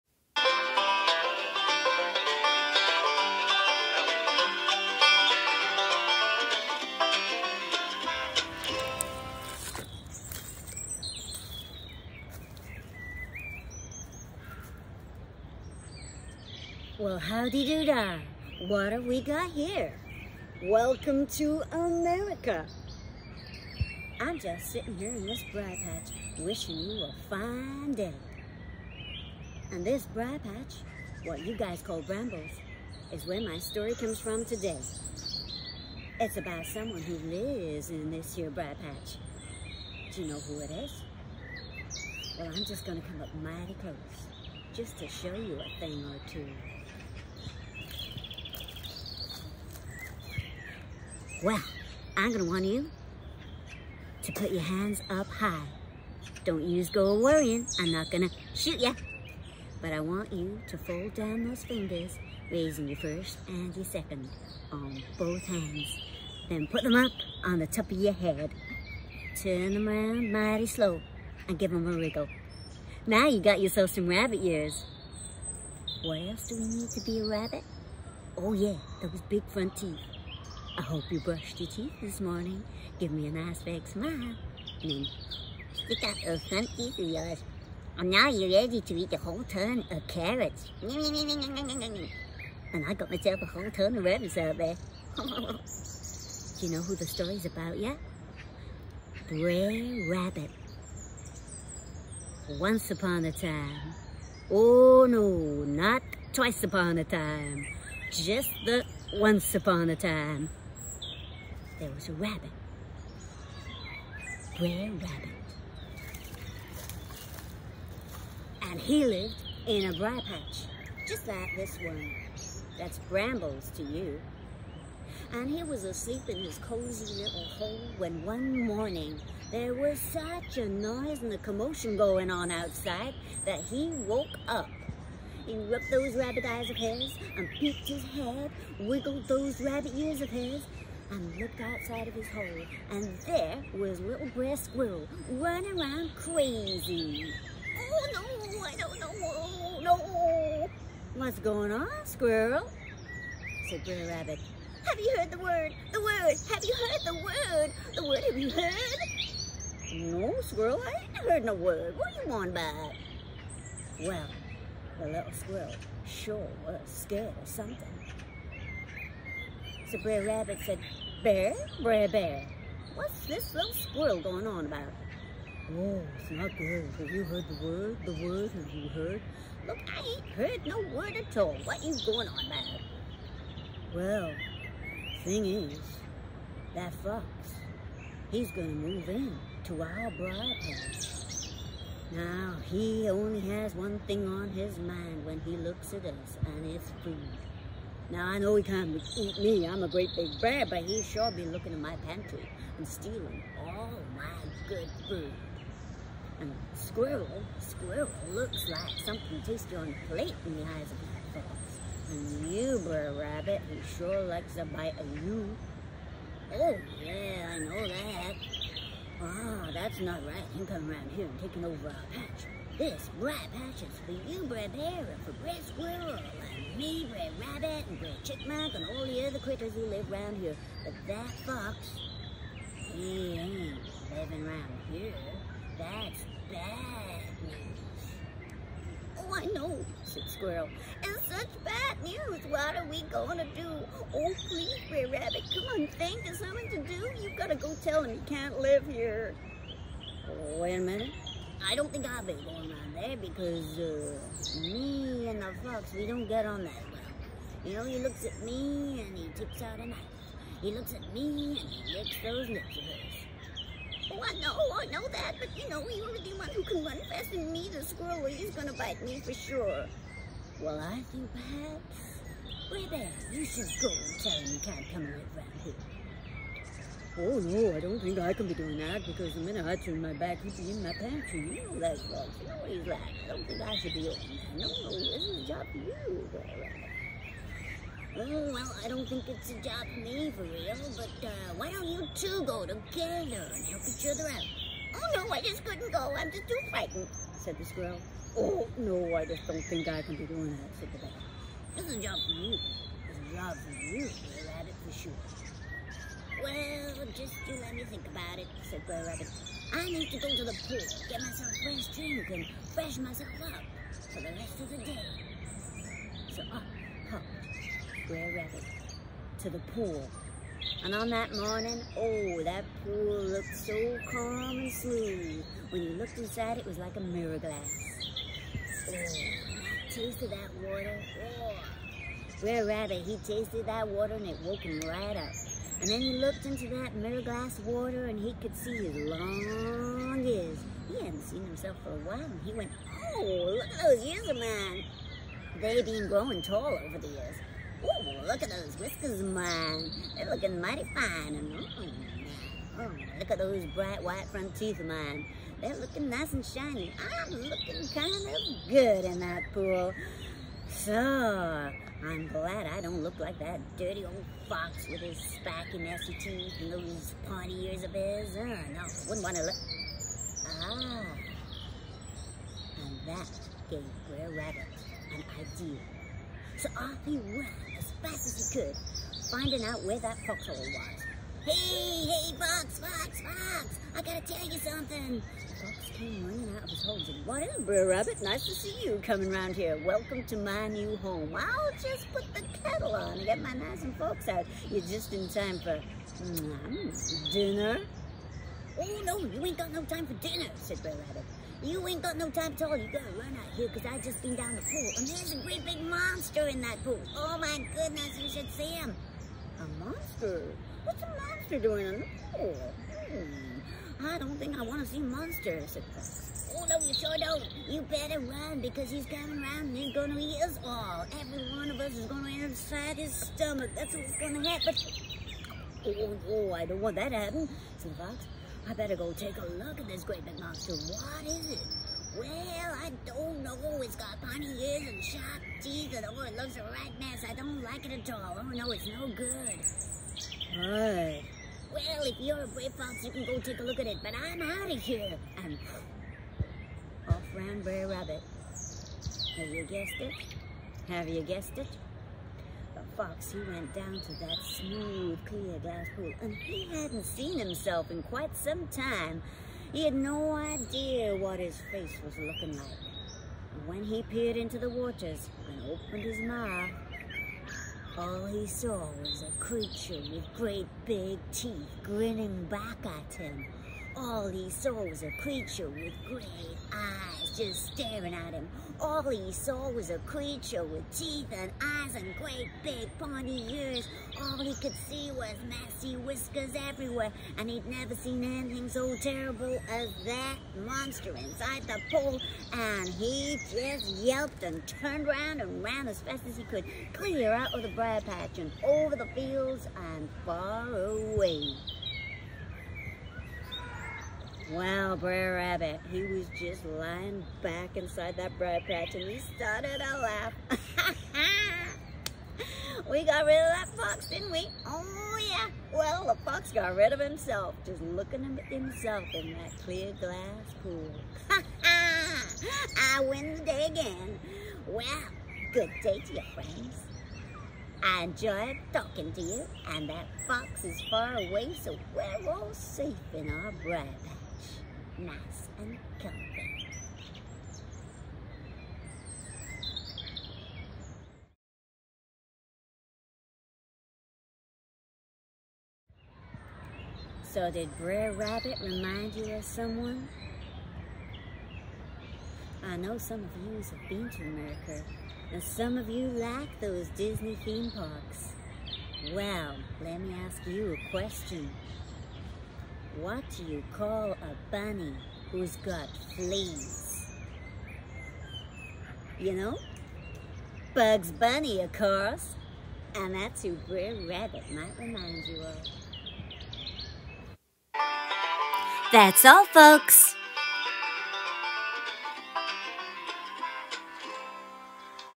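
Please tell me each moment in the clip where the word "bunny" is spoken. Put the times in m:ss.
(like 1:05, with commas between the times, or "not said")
9:24, 9:31.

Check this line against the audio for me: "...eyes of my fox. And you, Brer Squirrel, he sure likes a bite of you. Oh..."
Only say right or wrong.
wrong.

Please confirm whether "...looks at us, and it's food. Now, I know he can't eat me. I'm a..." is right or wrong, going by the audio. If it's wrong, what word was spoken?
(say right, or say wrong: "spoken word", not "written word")
right.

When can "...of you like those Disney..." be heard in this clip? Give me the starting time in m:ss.
9:15.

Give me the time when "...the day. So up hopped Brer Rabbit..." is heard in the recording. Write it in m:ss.
5:14.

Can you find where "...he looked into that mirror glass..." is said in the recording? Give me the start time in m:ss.
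5:36.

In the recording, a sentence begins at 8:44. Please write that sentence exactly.
Well, good day to you, friends.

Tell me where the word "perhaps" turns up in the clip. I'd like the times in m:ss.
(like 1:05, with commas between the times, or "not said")
4:31.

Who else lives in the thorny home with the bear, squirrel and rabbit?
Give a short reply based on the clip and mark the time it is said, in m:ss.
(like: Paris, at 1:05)
Brer Chipmunk, at 3:47.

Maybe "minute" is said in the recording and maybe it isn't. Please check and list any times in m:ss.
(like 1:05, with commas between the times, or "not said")
4:10, 4:39.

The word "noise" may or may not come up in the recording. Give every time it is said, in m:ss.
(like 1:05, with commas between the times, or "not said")
2:10.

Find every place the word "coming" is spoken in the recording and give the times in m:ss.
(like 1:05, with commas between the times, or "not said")
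3:40, 6:29, 6:59.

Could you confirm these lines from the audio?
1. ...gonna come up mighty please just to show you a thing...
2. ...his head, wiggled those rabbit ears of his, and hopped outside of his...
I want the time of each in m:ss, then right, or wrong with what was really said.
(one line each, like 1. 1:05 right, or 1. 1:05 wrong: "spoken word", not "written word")
1. 0:42 wrong: "close", not "please"
2. 2:17 wrong: "looked", not "hopped".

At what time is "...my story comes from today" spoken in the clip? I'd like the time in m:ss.
0:33.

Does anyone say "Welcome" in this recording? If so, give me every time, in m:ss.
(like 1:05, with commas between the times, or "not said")
0:20, 6:29.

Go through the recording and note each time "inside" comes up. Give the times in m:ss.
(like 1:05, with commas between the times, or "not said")
5:26, 7:02, 8:11, 8:27.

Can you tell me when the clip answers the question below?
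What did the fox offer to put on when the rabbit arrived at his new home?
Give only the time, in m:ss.
6:31.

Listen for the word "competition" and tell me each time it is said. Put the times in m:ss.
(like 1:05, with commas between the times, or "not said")
not said.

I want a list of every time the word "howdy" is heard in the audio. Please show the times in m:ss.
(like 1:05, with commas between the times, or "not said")
0:17.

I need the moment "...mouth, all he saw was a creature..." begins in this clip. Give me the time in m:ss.
7:46.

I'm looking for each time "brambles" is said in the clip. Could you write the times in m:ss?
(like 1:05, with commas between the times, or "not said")
0:32, 2:03.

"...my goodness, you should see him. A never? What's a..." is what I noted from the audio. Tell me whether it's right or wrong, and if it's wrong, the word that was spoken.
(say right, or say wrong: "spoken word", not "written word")
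wrong: "monster", not "never".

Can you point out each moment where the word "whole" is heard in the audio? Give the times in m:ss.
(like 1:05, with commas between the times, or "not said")
1:29, 1:33.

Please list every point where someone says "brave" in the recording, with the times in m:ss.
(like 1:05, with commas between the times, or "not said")
7:22.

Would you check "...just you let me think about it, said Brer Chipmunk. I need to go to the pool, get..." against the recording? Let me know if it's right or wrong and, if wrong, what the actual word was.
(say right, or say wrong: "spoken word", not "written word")
wrong: "Rabbit", not "Chipmunk".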